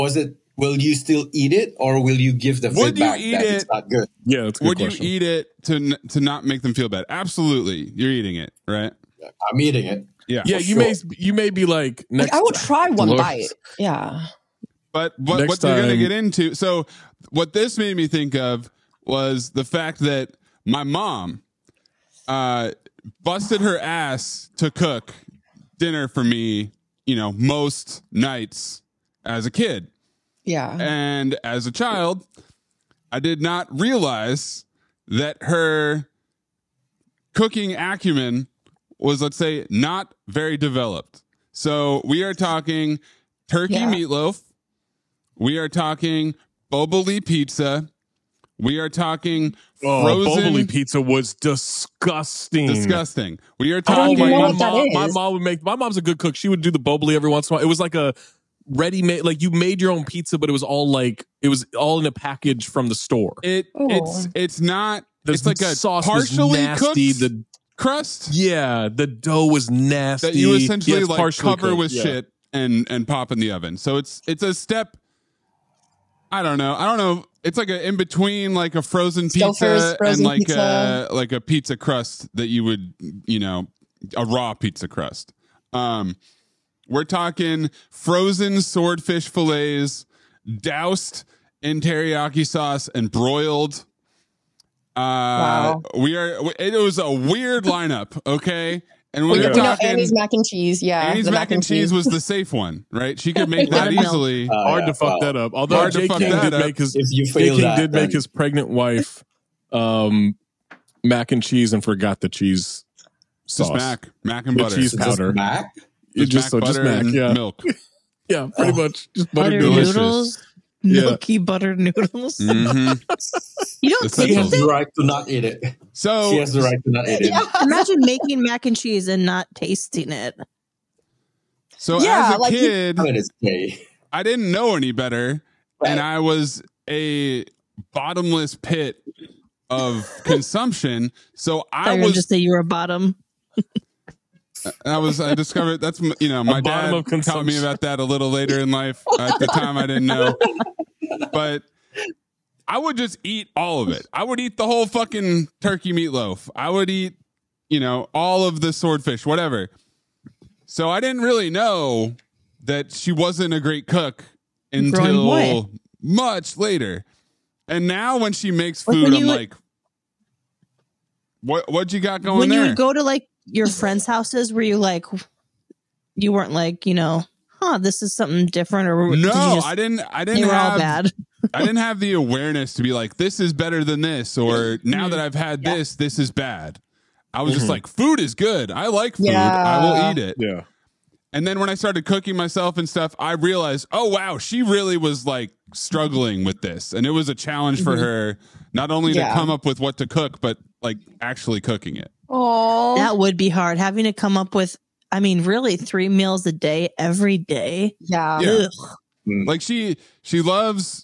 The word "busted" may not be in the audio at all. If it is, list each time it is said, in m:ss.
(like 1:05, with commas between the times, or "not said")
0:23.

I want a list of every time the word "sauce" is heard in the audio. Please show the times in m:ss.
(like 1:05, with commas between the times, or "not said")
1:05, 1:32, 1:53.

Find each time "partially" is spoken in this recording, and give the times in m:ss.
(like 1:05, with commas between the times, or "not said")
1:06.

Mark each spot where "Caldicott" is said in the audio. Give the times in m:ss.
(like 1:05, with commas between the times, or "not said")
not said.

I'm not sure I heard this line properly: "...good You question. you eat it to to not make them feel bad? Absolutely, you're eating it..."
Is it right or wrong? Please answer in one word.
wrong.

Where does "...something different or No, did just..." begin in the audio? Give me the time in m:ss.
2:58.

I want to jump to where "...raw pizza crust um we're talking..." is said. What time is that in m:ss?
1:24.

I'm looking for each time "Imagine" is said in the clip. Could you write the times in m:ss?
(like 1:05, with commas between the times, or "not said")
2:07.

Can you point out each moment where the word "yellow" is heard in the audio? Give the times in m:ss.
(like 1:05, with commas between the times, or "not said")
not said.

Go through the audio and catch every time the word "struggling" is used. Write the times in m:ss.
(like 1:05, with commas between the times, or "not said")
3:15.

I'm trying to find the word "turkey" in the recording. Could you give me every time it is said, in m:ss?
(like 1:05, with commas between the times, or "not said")
0:43, 2:35.